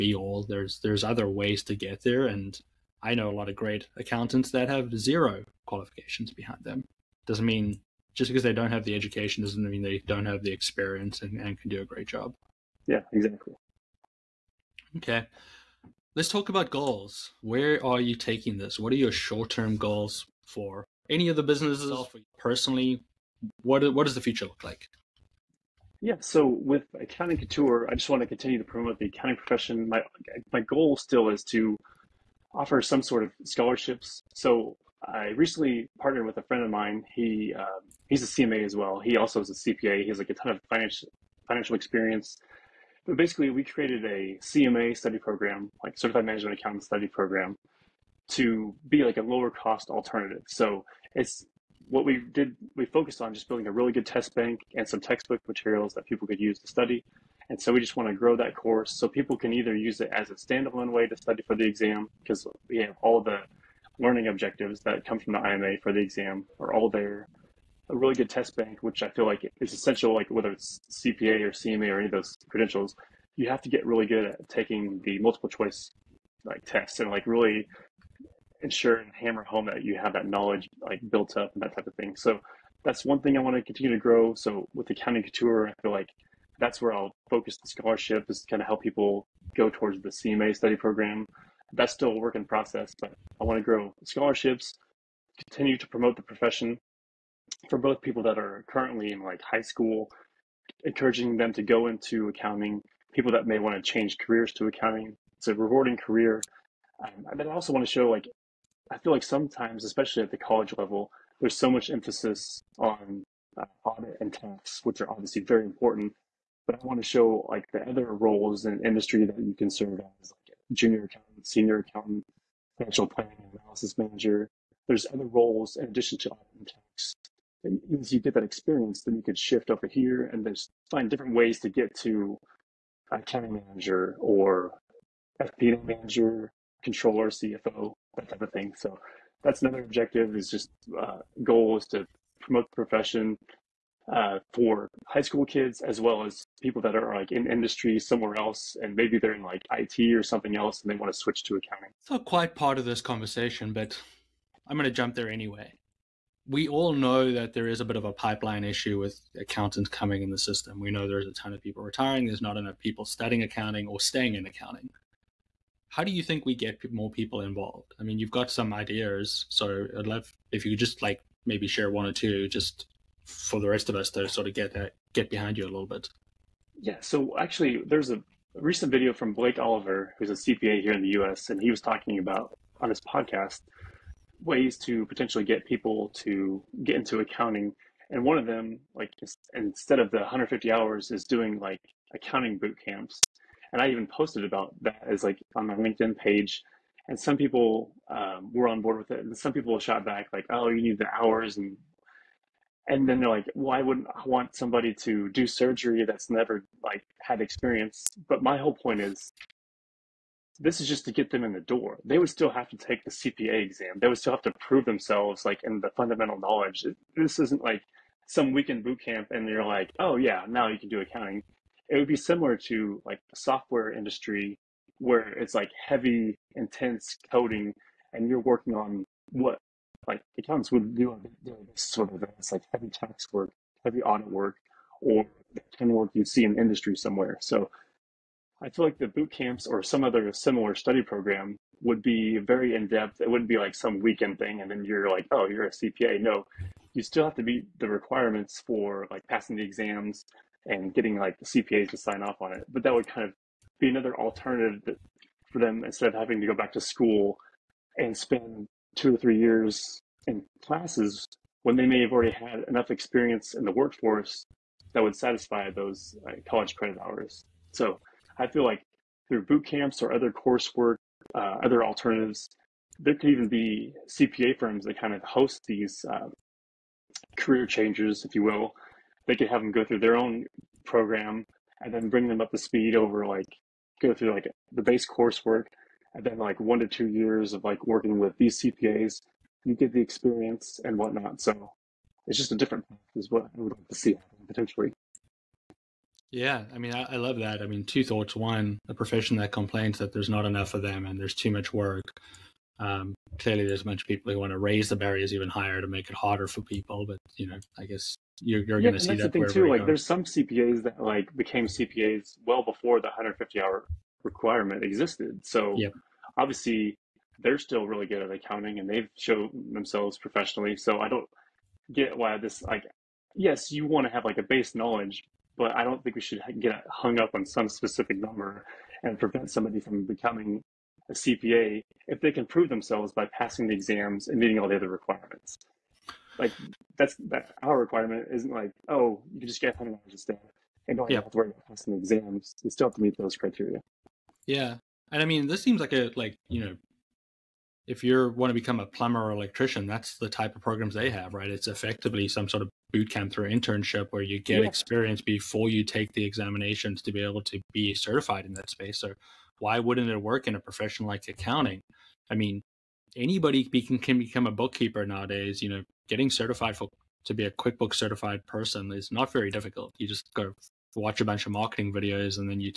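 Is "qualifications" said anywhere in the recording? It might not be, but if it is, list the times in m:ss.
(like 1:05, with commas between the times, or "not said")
0:05.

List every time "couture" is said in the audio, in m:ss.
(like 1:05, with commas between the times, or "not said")
0:27, 1:25.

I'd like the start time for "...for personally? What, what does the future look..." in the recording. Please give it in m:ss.
0:21.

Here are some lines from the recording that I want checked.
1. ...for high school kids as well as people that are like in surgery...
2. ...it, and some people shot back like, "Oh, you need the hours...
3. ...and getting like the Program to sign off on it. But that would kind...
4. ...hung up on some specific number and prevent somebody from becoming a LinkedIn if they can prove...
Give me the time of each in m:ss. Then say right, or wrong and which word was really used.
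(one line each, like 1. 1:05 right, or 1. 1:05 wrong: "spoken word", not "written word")
1. 2:24 wrong: "industry", not "surgery"
2. 3:19 right
3. 4:10 wrong: "CPAs", not "Program"
4. 5:26 wrong: "CPA", not "LinkedIn".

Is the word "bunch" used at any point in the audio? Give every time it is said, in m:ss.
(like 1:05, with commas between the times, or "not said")
5:03, 6:11.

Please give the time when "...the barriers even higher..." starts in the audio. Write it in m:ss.
5:04.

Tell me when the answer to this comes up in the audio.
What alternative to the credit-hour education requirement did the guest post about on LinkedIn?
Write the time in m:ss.
3:12.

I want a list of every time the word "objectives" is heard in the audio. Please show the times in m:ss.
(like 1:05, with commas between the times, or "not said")
1:04, 2:19.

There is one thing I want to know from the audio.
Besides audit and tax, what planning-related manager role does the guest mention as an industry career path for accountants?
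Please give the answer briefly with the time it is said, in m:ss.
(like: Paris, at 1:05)
Financial planning and analysis manager, at 2:02.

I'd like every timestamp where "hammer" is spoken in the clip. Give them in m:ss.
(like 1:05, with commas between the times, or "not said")
1:19.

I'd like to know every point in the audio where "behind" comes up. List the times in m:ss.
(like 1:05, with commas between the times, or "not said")
0:06, 2:55.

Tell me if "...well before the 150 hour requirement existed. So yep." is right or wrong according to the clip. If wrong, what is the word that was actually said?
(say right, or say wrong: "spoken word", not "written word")
right.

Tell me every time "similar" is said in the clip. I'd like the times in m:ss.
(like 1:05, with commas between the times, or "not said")
3:42, 4:00.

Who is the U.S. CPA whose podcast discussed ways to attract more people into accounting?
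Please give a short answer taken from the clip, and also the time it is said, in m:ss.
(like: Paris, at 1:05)
Blake Oliver, at 2:59.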